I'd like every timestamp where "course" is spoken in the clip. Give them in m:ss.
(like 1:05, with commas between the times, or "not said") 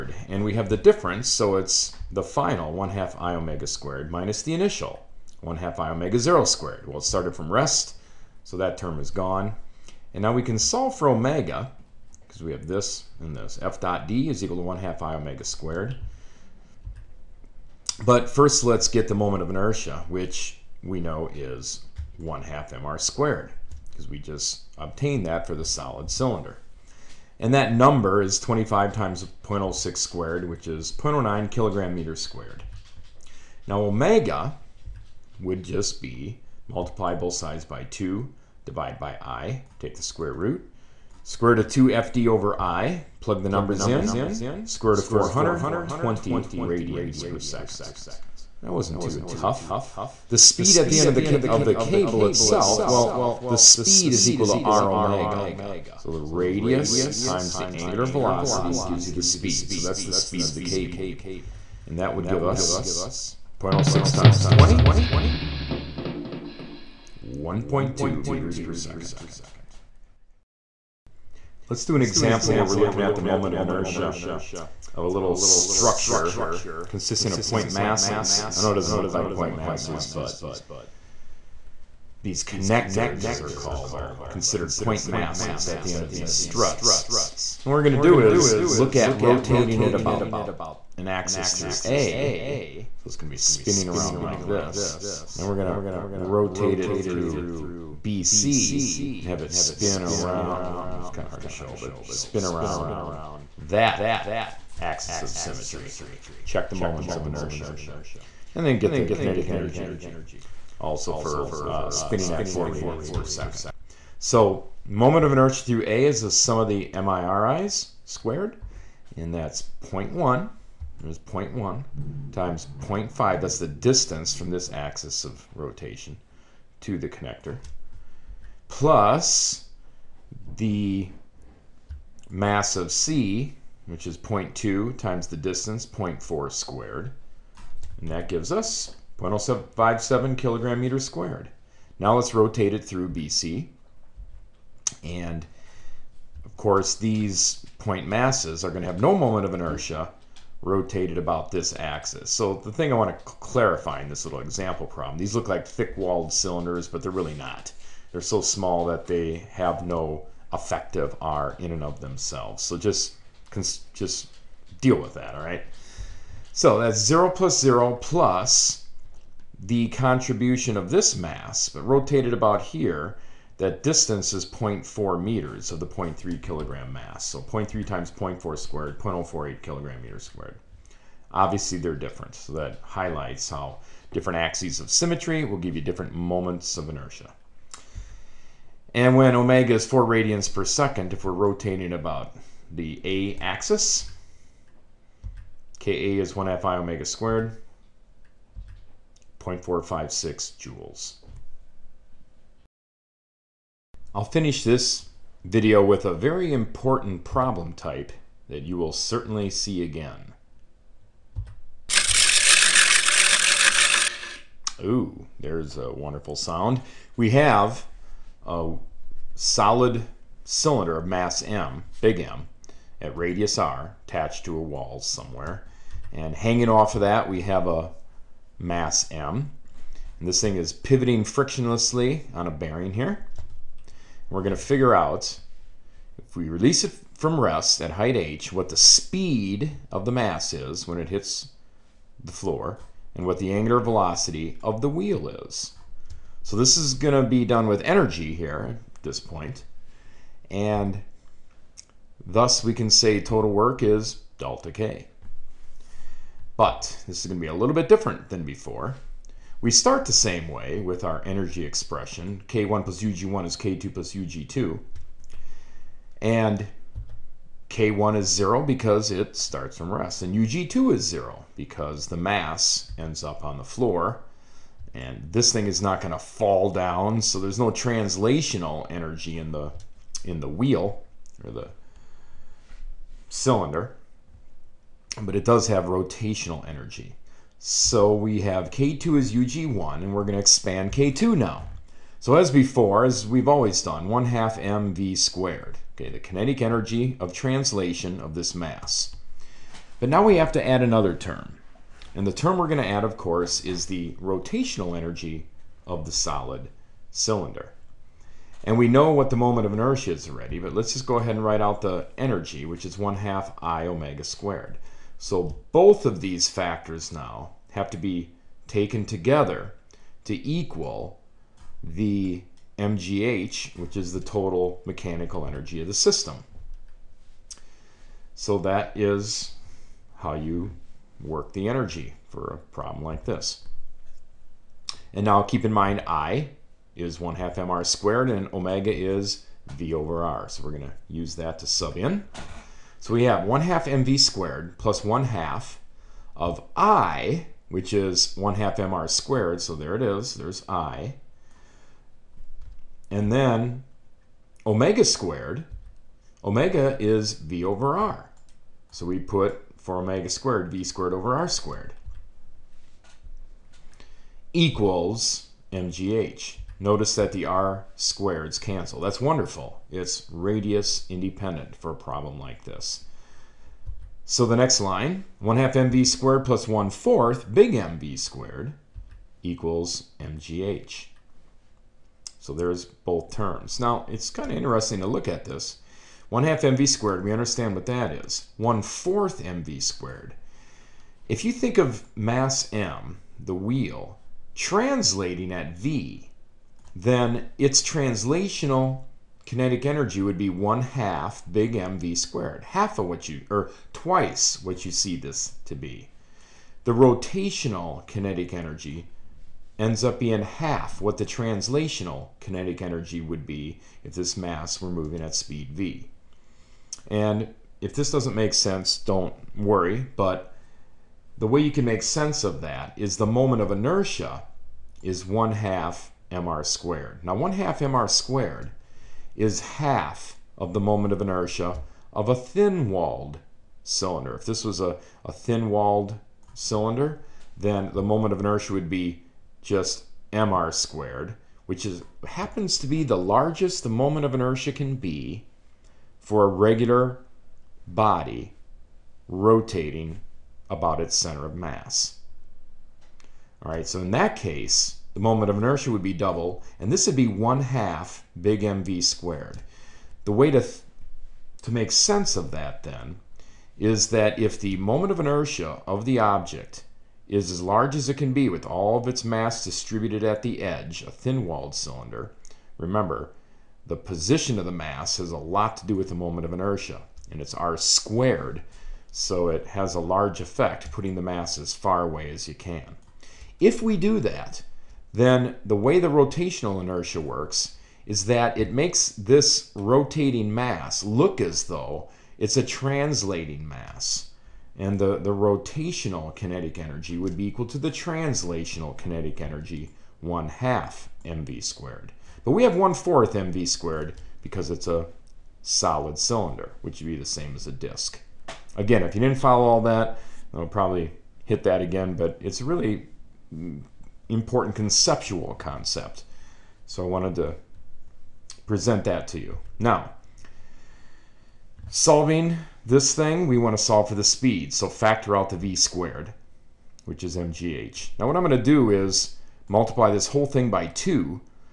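2:26, 5:03.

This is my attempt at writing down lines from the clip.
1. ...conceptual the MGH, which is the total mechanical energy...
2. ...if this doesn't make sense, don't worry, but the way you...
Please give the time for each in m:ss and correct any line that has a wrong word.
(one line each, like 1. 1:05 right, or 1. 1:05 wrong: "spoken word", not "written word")
1. 5:20 wrong: "equal", not "conceptual"
2. 6:57 right.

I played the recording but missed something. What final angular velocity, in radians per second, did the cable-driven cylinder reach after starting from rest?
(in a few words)
20.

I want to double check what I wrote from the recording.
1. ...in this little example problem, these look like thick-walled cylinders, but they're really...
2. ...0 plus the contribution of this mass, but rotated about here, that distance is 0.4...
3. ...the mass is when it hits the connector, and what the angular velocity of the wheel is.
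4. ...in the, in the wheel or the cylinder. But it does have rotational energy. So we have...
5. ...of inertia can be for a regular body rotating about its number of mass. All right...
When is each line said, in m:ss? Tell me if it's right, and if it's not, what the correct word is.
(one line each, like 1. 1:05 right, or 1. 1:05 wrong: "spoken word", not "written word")
1. 2:34 right
2. 2:47 right
3. 4:00 wrong: "floor", not "connector"
4. 4:39 right
5. 7:24 wrong: "center", not "number".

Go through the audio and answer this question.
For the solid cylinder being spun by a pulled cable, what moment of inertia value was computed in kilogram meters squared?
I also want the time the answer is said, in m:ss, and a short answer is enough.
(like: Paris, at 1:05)
0.09, at 0:30.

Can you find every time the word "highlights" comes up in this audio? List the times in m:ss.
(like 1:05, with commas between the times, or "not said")
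3:02.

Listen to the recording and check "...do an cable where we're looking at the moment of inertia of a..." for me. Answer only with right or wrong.
wrong.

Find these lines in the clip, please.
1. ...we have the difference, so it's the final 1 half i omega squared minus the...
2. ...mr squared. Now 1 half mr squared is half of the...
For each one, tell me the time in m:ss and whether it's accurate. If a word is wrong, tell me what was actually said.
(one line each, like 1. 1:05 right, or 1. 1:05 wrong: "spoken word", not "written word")
1. 0:00 right
2. 7:06 right.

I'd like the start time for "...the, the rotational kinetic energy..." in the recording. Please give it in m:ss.
8:14.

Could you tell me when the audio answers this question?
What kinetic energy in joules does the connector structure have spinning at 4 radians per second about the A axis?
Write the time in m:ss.
3:19.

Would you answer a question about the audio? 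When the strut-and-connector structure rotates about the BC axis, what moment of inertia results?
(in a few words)
0.048 kilogram meters squared.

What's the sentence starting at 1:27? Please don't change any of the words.
And what we're going to do is look at rotating it about an axis through A.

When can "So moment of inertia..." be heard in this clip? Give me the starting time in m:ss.
1:54.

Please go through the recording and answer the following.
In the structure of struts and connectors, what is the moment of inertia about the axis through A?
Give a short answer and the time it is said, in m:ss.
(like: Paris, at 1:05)
0.057 kilogram meters squared, at 2:19.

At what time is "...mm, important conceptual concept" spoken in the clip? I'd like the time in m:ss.
8:33.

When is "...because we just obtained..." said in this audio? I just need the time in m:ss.
0:23.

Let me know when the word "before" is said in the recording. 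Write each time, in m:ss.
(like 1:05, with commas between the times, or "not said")
4:18, 4:52.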